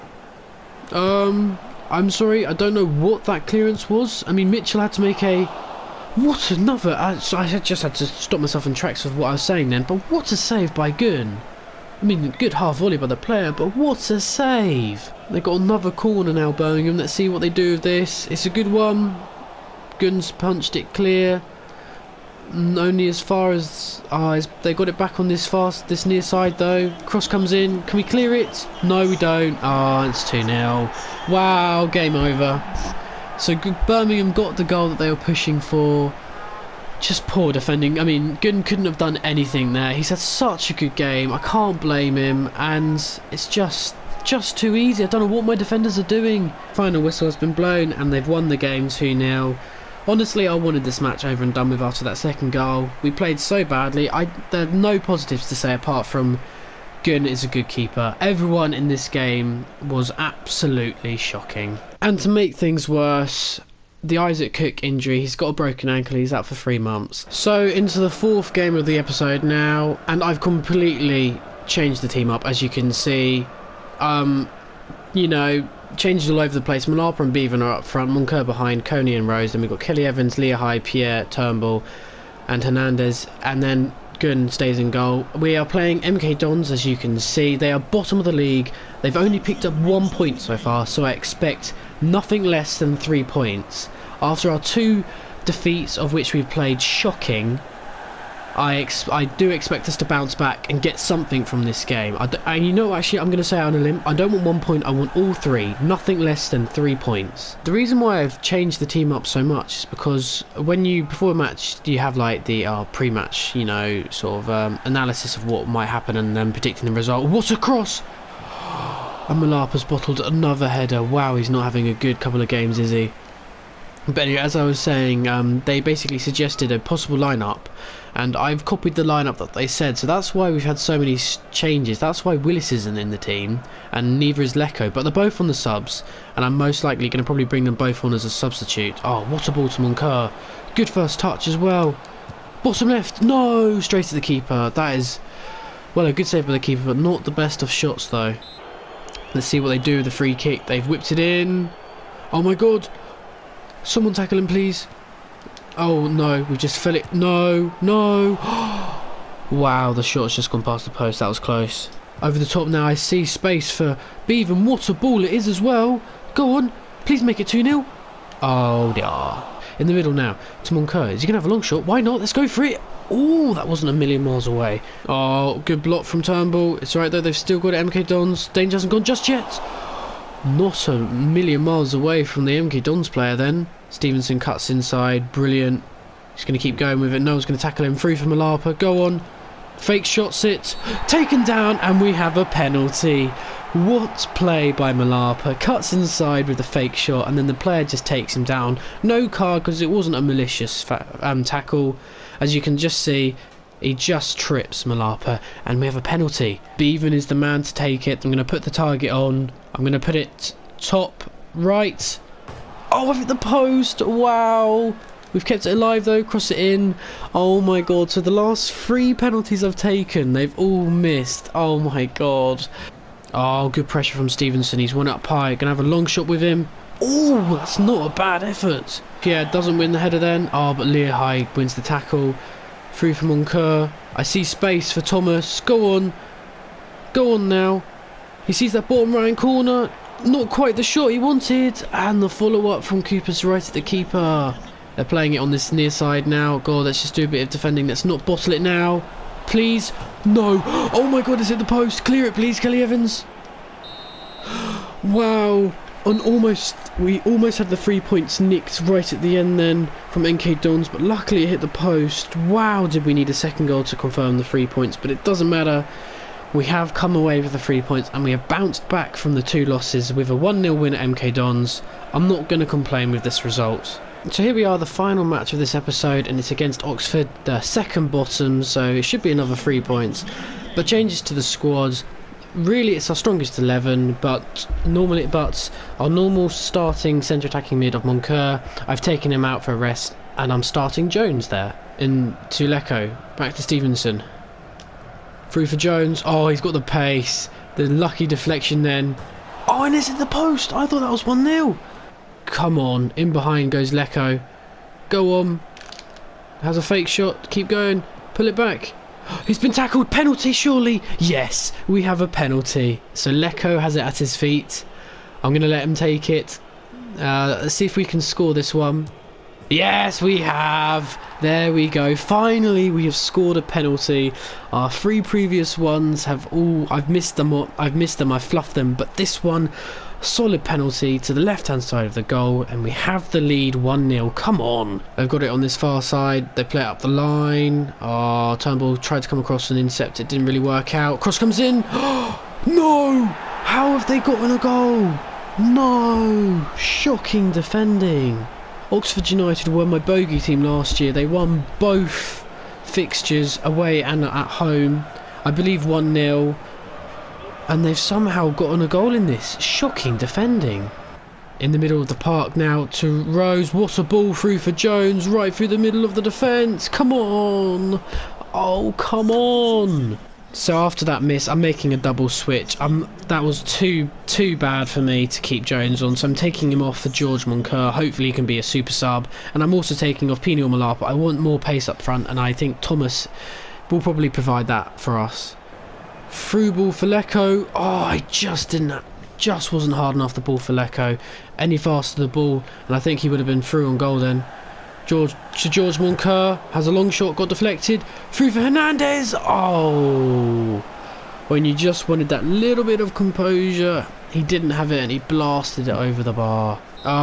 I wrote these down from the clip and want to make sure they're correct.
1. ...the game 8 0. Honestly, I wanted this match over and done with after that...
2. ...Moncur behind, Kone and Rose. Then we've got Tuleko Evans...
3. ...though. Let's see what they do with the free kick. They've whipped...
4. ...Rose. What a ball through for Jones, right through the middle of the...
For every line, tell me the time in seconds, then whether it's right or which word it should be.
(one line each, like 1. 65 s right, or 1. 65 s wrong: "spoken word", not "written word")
1. 48 s wrong: "2", not "8"
2. 78 s wrong: "Kelly", not "Tuleko"
3. 148 s right
4. 363 s right.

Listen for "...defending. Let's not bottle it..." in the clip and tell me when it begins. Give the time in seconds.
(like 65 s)
247 s.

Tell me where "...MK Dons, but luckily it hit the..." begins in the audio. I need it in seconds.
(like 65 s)
260 s.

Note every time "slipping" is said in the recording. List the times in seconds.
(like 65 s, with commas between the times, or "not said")
not said.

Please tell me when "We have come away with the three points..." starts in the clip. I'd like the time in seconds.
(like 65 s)
266 s.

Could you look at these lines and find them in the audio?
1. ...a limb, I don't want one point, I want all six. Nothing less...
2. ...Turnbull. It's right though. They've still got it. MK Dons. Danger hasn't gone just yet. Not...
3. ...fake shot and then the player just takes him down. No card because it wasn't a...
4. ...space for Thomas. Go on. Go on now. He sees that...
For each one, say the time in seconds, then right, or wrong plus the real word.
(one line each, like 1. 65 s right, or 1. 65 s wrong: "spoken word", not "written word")
1. 103 s wrong: "three", not "six"
2. 176 s right
3. 196 s right
4. 234 s right.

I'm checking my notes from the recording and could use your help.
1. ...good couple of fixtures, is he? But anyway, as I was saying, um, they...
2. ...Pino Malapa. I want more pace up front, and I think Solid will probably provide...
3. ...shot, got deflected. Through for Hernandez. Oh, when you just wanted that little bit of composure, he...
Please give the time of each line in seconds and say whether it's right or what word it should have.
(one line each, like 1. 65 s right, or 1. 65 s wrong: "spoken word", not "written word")
1. 121 s wrong: "games", not "fixtures"
2. 380 s wrong: "Thomas", not "Solid"
3. 397 s right.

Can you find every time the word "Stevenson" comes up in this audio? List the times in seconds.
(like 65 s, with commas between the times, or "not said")
183 s, 224 s, 293 s.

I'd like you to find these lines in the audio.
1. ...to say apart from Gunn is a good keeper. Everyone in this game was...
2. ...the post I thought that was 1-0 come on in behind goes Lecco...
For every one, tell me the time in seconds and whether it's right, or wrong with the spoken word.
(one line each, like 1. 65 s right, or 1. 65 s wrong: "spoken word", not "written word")
1. 55 s right
2. 300 s right.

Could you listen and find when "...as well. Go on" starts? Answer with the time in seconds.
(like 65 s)
165 s.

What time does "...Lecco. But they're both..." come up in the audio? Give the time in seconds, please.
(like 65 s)
134 s.